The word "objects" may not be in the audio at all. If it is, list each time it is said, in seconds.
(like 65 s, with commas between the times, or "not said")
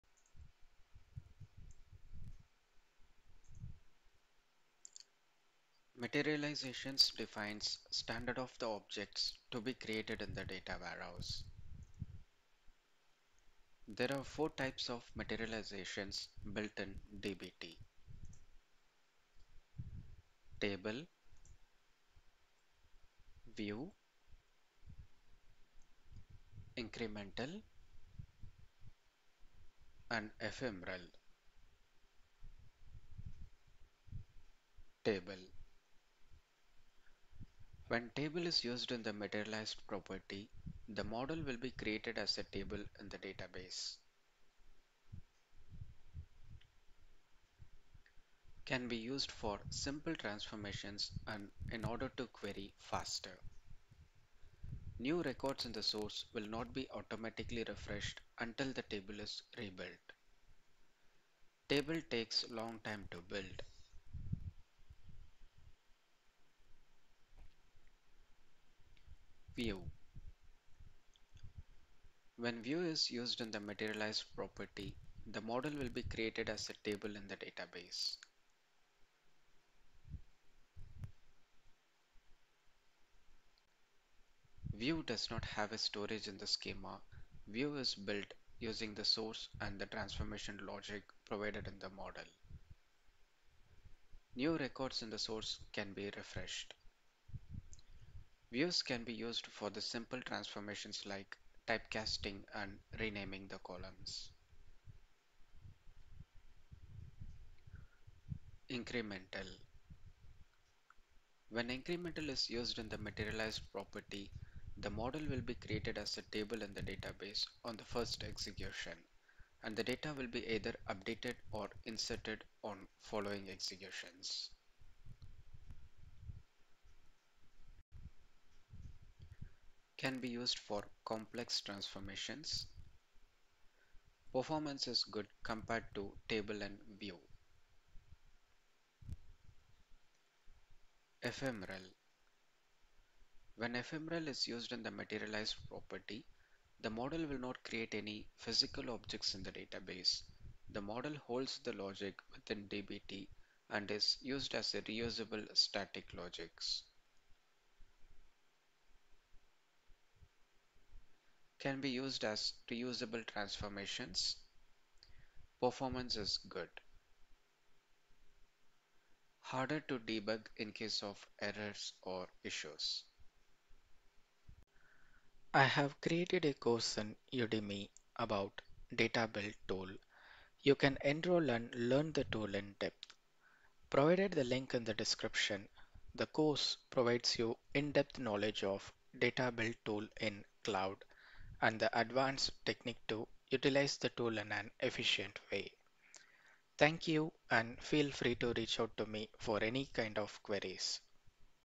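8 s, 148 s.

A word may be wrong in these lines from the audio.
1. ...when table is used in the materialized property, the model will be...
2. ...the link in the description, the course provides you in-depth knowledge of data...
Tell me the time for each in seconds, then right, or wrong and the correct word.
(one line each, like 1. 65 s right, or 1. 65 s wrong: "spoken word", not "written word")
1. 37 s right
2. 184 s right.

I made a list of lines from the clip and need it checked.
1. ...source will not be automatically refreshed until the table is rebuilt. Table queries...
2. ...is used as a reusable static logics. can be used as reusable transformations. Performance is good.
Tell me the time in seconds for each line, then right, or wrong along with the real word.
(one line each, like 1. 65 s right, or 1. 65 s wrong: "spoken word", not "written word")
1. 55 s wrong: "takes", not "queries"
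2. 153 s right.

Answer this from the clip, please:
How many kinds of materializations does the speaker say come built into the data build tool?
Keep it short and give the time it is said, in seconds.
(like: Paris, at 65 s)
4, at 14 s.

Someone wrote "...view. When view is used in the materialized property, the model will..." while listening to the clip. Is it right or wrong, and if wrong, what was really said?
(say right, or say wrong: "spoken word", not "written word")
right.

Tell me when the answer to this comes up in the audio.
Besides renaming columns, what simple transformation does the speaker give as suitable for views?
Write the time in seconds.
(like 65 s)
101 s.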